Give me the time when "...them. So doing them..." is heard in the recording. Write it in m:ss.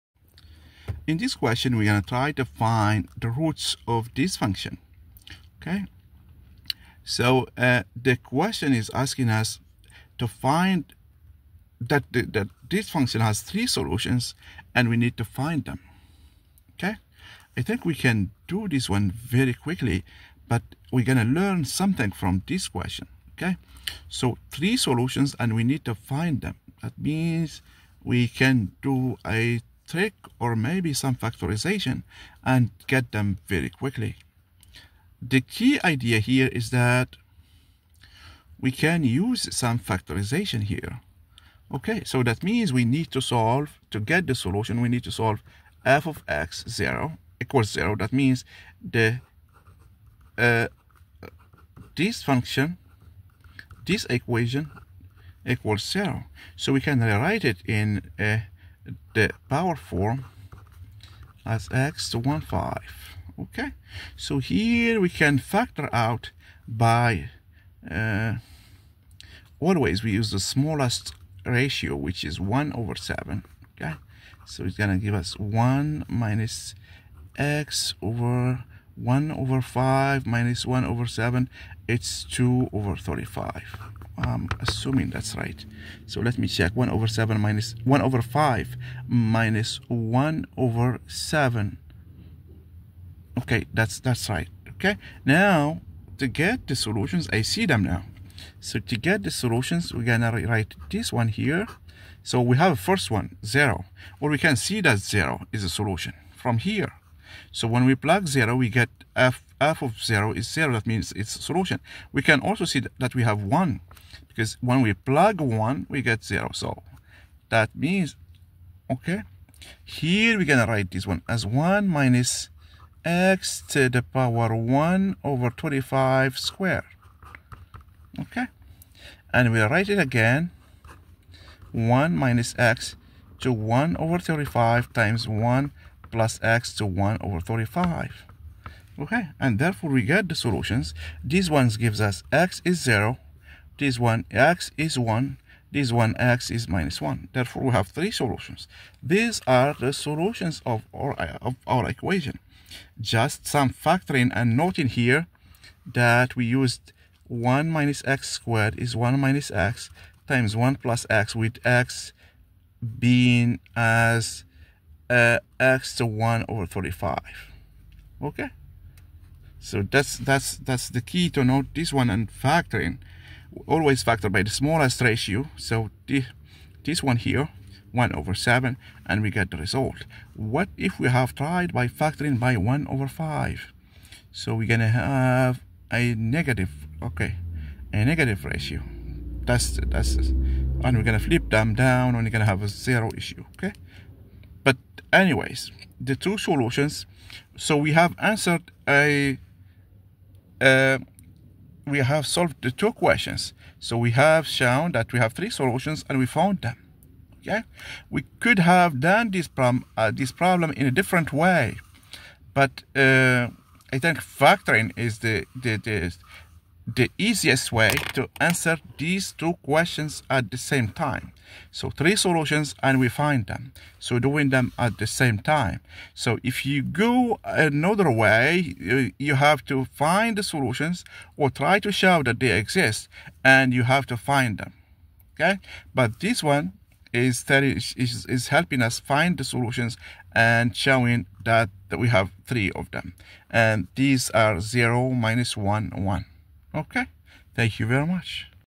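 3:43.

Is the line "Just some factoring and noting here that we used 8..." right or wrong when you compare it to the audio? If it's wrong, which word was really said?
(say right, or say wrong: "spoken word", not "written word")
wrong: "1", not "8".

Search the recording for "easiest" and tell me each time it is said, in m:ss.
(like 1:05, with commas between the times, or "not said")
3:37.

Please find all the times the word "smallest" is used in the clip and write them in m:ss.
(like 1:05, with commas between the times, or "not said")
1:10, 2:54.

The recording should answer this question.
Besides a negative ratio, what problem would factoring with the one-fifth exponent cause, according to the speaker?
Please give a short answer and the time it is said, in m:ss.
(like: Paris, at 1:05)
a zero issue, at 3:12.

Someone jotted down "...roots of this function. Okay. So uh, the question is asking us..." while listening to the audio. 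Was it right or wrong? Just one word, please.
right.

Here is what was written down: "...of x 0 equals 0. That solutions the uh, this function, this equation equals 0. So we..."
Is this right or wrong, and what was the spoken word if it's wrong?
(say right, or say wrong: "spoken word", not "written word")
wrong: "means", not "solutions".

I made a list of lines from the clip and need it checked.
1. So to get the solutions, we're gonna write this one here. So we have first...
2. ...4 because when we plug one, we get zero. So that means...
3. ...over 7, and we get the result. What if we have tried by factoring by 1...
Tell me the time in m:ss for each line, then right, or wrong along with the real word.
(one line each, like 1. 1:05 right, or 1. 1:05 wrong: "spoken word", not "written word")
1. 1:38 right
2. 1:53 wrong: "1", not "4"
3. 2:58 right.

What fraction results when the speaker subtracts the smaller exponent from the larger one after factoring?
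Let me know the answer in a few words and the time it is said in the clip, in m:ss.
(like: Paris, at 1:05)
2/35, at 1:22.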